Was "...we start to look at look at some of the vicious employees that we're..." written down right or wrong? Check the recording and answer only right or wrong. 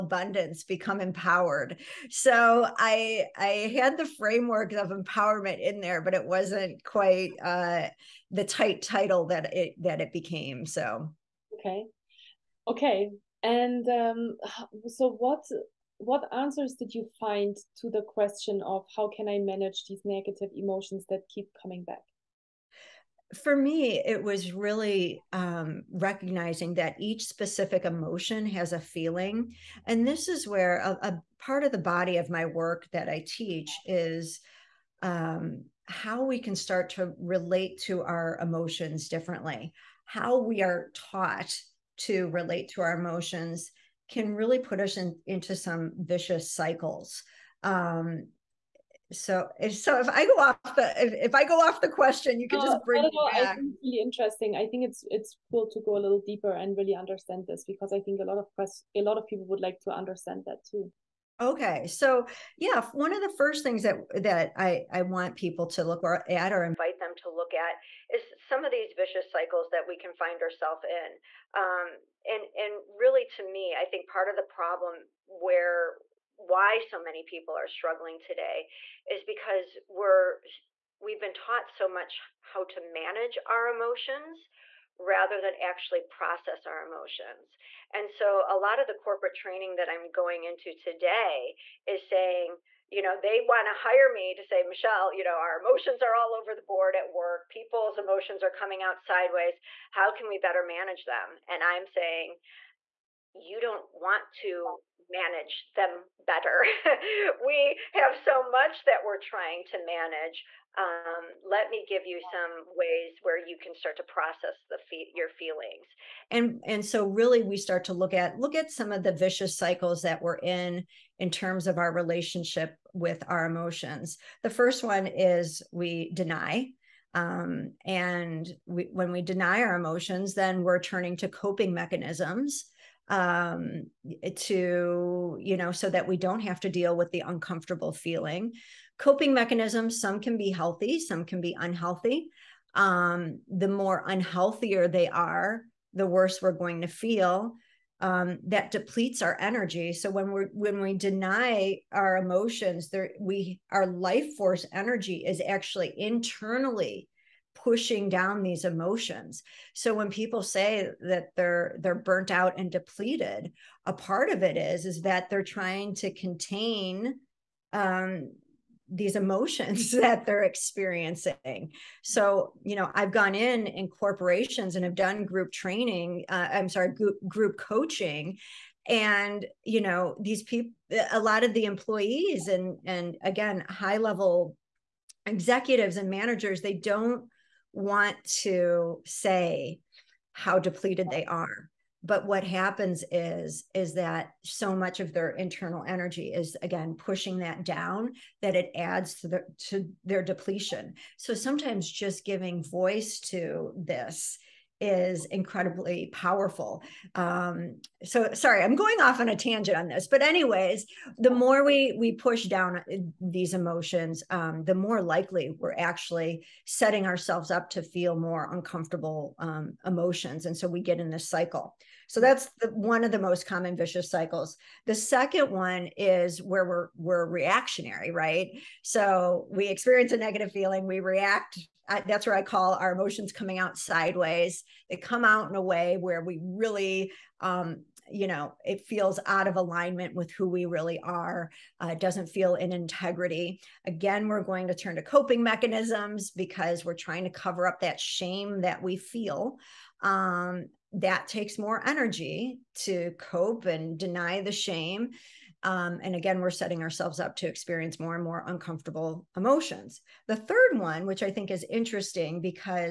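wrong.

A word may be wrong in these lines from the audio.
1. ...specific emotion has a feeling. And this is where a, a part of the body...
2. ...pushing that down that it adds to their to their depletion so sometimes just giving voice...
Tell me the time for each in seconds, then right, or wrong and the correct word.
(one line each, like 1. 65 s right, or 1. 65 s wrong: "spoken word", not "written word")
1. 27 s right
2. 196 s right.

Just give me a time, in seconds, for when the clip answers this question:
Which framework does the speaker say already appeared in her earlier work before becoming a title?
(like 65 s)
4 s.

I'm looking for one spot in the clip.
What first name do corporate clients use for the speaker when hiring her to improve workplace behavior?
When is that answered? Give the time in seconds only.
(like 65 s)
94 s.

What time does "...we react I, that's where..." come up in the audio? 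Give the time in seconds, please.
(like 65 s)
230 s.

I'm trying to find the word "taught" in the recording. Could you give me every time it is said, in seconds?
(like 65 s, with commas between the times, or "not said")
40 s, 81 s.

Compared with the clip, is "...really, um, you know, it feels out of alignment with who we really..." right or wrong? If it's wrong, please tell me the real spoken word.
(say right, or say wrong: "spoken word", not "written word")
right.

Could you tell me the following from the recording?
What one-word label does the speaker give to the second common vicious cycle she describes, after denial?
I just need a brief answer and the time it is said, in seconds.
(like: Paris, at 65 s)
reactionary, at 227 s.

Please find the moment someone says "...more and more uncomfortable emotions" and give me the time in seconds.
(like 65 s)
257 s.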